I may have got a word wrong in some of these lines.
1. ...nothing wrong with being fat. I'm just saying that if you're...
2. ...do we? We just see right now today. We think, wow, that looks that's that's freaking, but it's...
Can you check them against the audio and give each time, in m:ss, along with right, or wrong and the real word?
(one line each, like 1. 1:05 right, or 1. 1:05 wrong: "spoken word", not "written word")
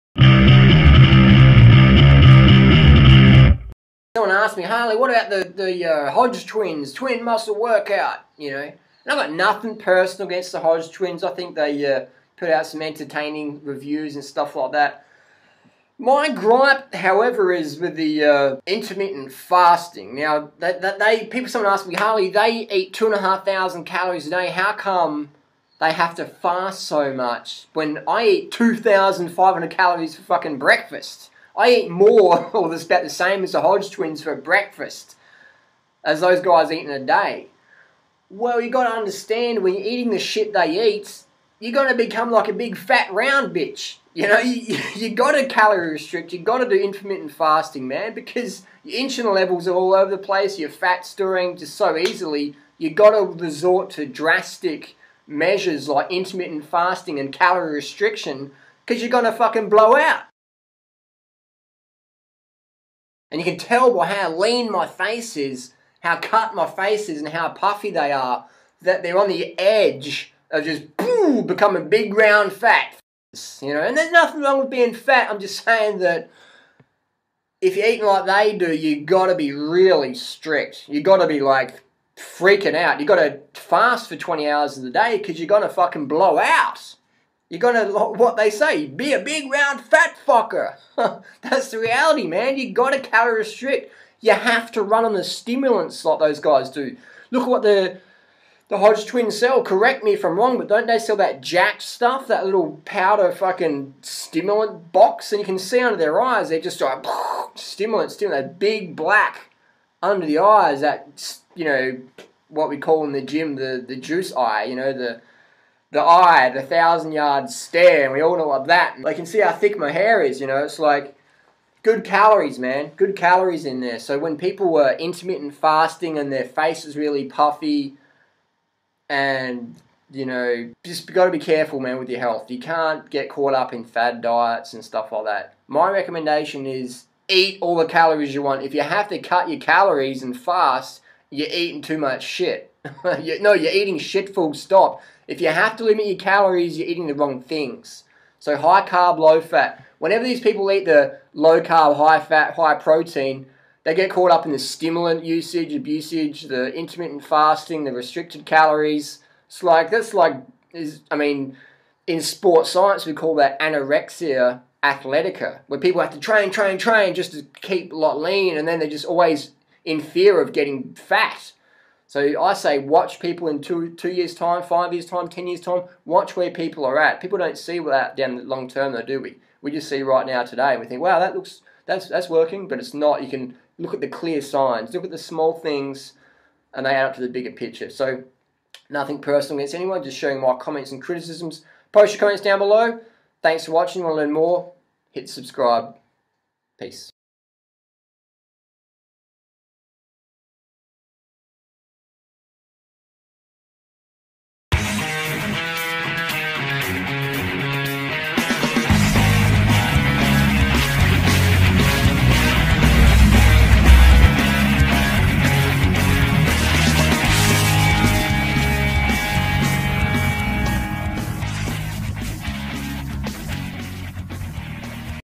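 1. 1:14 right
2. 2:59 wrong: "working", not "freaking".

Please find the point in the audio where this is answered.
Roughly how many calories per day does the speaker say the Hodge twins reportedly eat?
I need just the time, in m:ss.
0:22.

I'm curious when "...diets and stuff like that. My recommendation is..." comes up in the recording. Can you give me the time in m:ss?
2:14.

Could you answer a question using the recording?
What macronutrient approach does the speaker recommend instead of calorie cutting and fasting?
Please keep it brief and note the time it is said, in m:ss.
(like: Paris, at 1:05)
High carb, low fat, at 2:28.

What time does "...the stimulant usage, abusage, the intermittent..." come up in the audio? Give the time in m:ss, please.
2:34.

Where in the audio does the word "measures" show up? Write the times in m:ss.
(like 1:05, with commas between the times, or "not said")
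0:55.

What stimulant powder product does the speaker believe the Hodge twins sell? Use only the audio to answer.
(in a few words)
Jack.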